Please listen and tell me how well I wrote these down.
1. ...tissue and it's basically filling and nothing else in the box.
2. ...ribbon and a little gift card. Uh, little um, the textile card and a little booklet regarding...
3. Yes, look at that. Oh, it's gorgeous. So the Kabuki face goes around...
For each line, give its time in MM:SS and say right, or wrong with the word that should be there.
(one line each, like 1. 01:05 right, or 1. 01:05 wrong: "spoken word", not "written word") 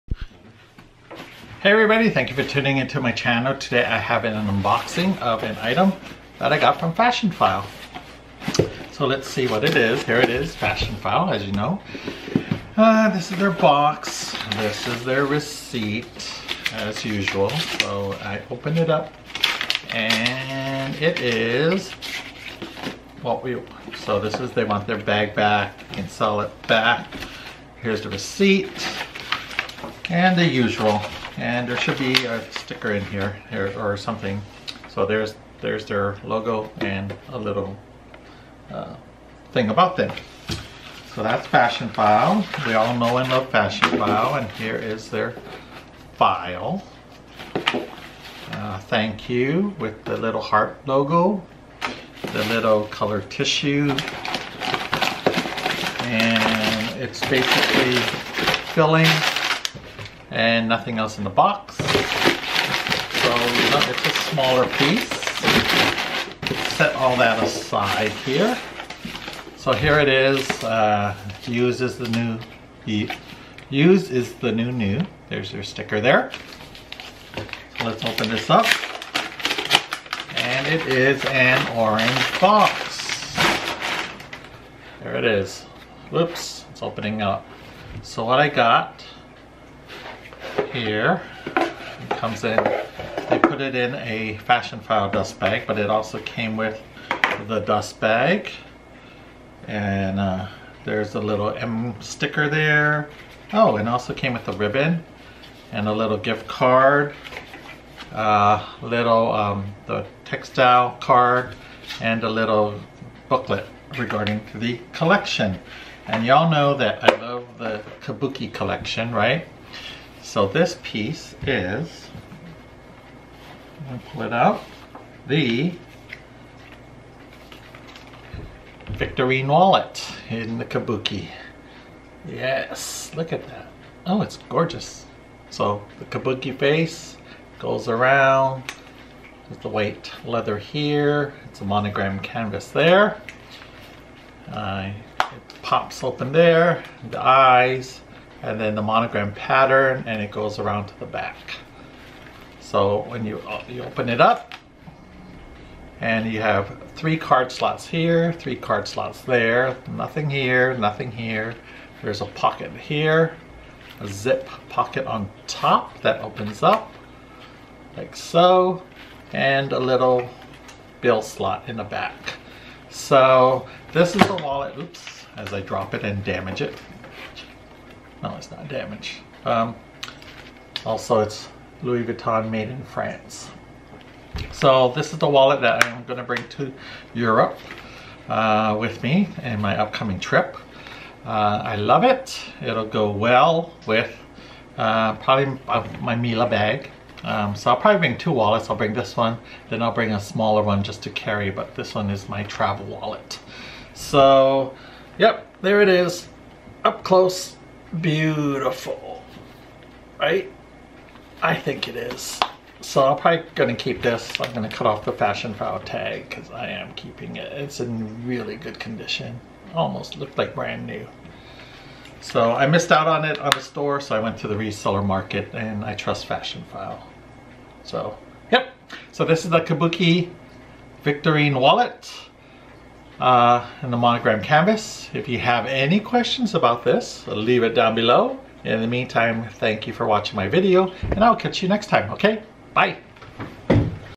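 1. 00:53 right
2. 01:44 right
3. 02:12 right.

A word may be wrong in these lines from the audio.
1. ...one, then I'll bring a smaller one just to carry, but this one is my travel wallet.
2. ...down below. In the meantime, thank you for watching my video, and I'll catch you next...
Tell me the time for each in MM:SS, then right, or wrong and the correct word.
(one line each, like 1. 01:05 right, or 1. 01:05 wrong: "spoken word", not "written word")
1. 03:19 right
2. 03:57 right.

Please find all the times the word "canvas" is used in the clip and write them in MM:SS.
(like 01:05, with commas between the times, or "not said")
02:22, 03:54.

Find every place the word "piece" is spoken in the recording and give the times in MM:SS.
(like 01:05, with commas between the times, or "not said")
01:04, 02:00.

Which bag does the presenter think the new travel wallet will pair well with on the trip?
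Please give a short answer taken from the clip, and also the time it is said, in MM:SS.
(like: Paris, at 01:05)
Mila bag, at 03:16.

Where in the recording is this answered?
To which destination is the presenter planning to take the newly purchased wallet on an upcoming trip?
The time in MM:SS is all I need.
03:07.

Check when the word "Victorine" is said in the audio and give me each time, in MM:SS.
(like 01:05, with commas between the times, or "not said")
02:08, 03:51.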